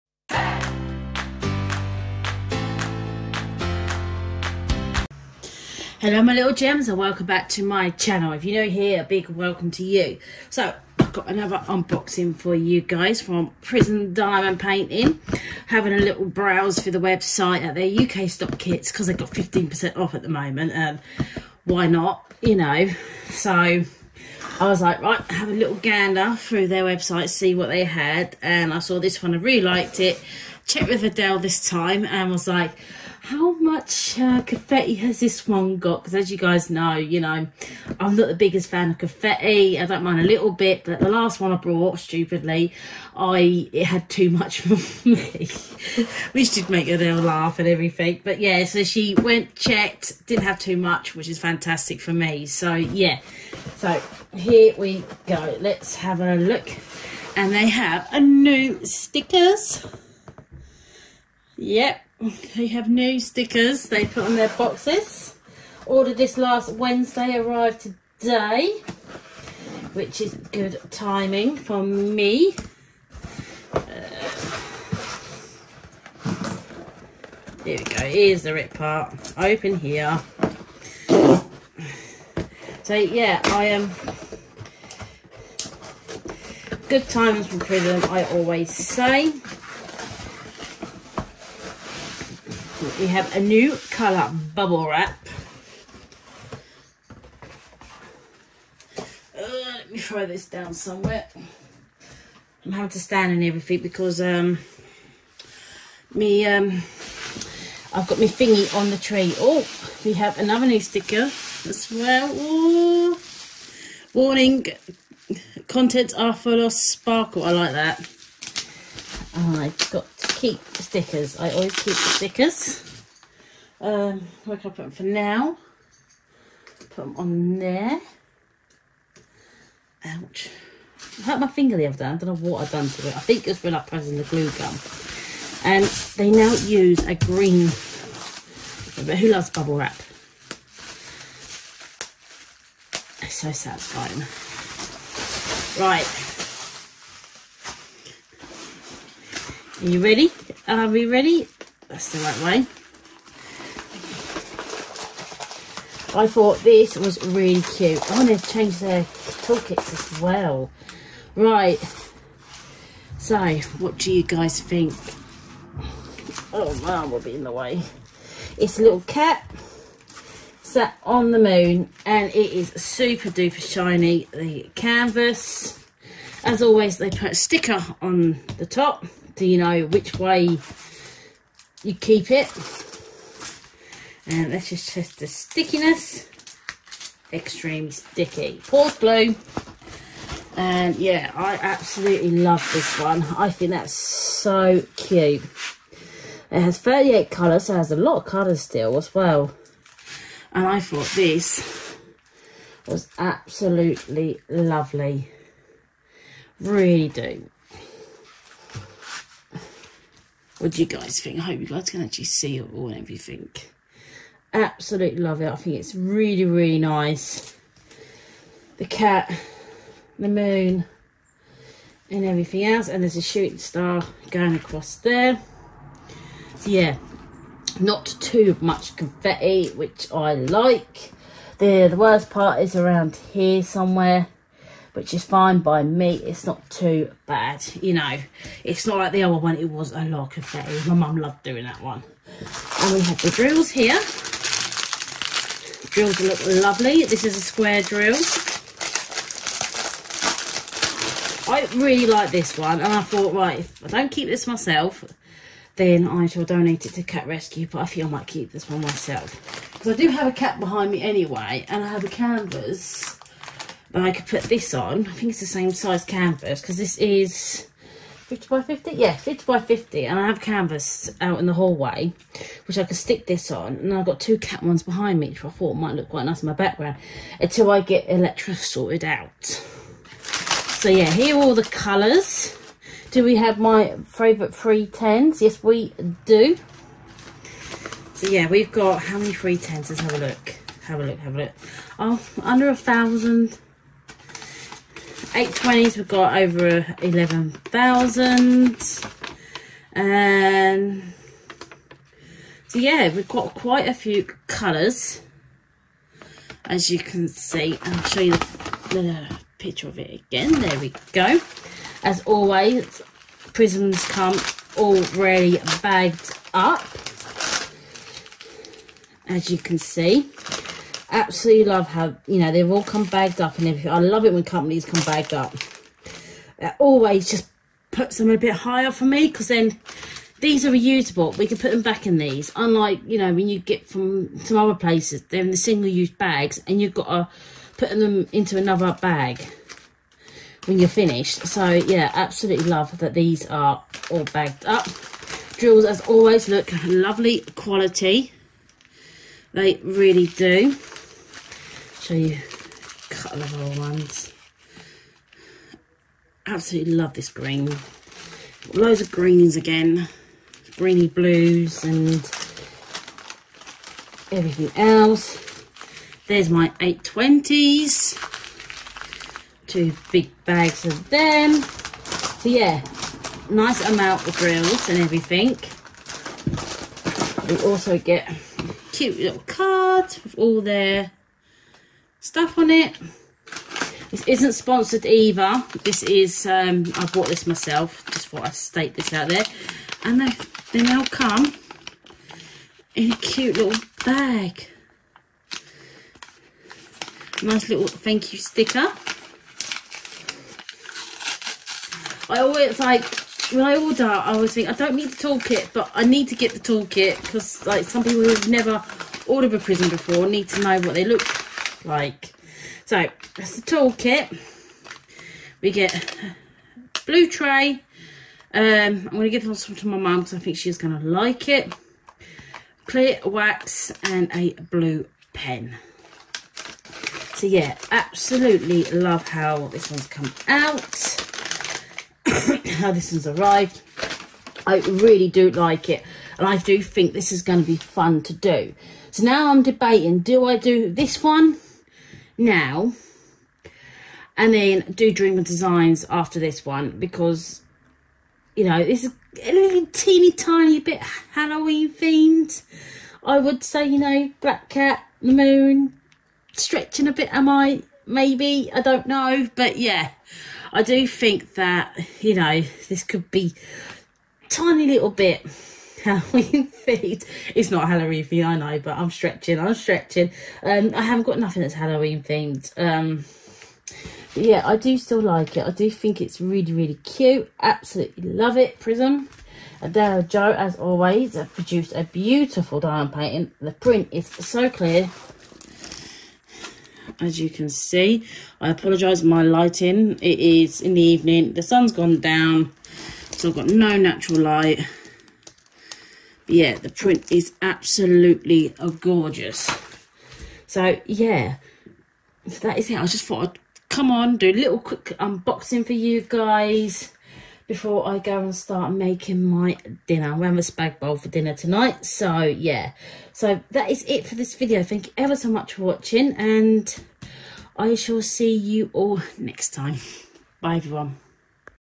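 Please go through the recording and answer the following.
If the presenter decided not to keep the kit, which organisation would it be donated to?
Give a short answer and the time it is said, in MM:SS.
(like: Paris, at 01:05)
Cat Rescue, at 04:17.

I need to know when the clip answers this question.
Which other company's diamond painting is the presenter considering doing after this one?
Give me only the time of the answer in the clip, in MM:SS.
07:25.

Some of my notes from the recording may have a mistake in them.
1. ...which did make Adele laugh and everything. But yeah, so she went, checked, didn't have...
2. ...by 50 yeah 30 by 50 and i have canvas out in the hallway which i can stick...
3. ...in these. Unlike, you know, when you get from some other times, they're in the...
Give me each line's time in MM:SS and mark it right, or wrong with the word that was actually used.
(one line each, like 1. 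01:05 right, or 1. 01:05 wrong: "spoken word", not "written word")
1. 00:46 right
2. 04:28 wrong: "50", not "30"
3. 05:32 wrong: "places", not "times".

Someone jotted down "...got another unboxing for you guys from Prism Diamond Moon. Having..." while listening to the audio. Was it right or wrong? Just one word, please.
wrong.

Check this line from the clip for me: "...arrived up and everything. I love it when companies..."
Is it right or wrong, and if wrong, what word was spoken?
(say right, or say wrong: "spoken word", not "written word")
wrong: "bagged", not "arrived".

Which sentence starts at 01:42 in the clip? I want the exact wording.
I'm having to stand and everything because um, me um, I've got my thingy on the tree.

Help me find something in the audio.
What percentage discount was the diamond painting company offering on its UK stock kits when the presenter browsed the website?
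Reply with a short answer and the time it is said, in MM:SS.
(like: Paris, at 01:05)
15%, at 00:19.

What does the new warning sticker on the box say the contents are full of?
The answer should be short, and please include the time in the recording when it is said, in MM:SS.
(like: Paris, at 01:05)
Sparkle, at 01:56.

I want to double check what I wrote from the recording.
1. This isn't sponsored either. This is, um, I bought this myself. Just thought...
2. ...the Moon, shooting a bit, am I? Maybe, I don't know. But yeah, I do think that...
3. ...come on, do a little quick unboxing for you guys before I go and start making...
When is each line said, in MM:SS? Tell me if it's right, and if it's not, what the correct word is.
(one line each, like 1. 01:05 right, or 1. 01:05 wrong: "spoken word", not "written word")
1. 06:24 right
2. 07:35 wrong: "stretching", not "shooting"
3. 08:23 right.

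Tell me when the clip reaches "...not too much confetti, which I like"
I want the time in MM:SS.
03:47.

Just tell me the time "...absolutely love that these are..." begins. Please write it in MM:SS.
05:42.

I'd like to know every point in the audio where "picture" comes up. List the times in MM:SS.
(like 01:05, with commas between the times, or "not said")
05:09.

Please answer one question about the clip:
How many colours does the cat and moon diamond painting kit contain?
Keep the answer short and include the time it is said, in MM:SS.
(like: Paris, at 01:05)
38, at 03:16.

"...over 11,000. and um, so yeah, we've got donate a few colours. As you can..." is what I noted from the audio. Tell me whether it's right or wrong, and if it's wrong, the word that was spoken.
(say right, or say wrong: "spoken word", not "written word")
wrong: "quite", not "donate".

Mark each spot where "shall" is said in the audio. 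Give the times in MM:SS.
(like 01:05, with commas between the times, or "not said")
04:16, 08:37.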